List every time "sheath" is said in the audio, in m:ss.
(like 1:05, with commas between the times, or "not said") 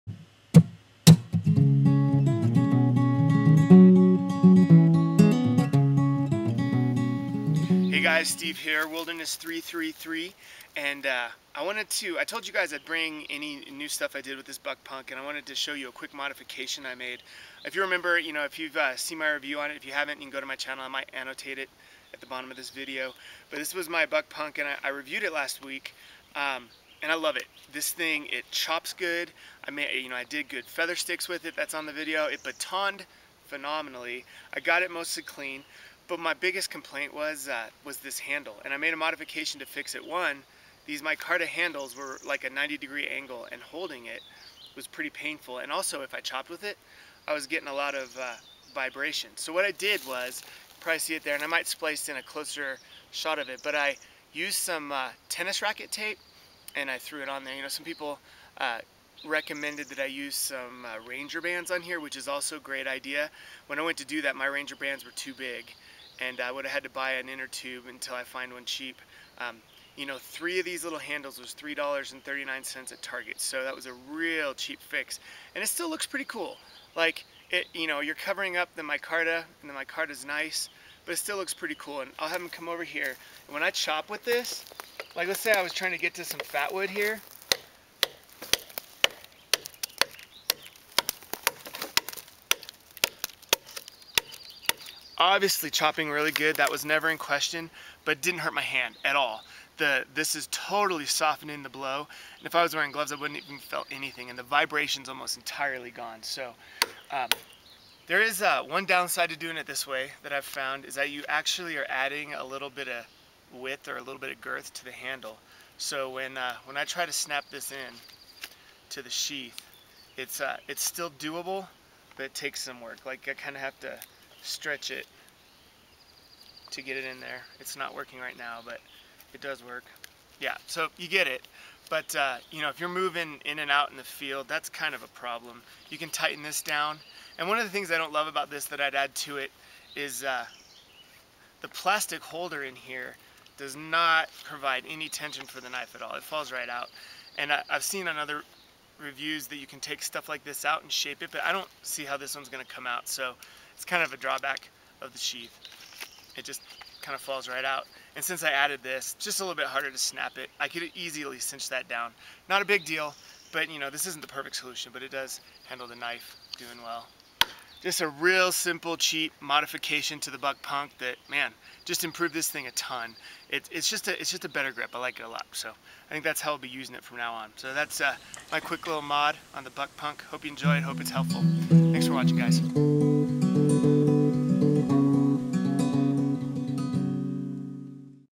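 1:59, 2:35.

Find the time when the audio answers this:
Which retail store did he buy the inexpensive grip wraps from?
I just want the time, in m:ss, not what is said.
1:13.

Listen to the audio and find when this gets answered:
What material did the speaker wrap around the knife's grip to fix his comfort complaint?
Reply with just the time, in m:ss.
0:55.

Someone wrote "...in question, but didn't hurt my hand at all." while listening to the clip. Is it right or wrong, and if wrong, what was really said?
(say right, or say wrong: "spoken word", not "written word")
right.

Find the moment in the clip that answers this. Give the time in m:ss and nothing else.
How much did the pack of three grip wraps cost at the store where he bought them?
1:11.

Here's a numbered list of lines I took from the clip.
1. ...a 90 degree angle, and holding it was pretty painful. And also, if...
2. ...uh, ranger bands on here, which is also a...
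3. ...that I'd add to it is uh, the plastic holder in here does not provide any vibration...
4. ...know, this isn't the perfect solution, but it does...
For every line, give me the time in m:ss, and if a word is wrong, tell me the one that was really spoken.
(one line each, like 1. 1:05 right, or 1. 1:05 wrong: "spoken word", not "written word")
1. 0:42 right
2. 1:00 right
3. 2:18 wrong: "tension", not "vibration"
4. 2:43 right.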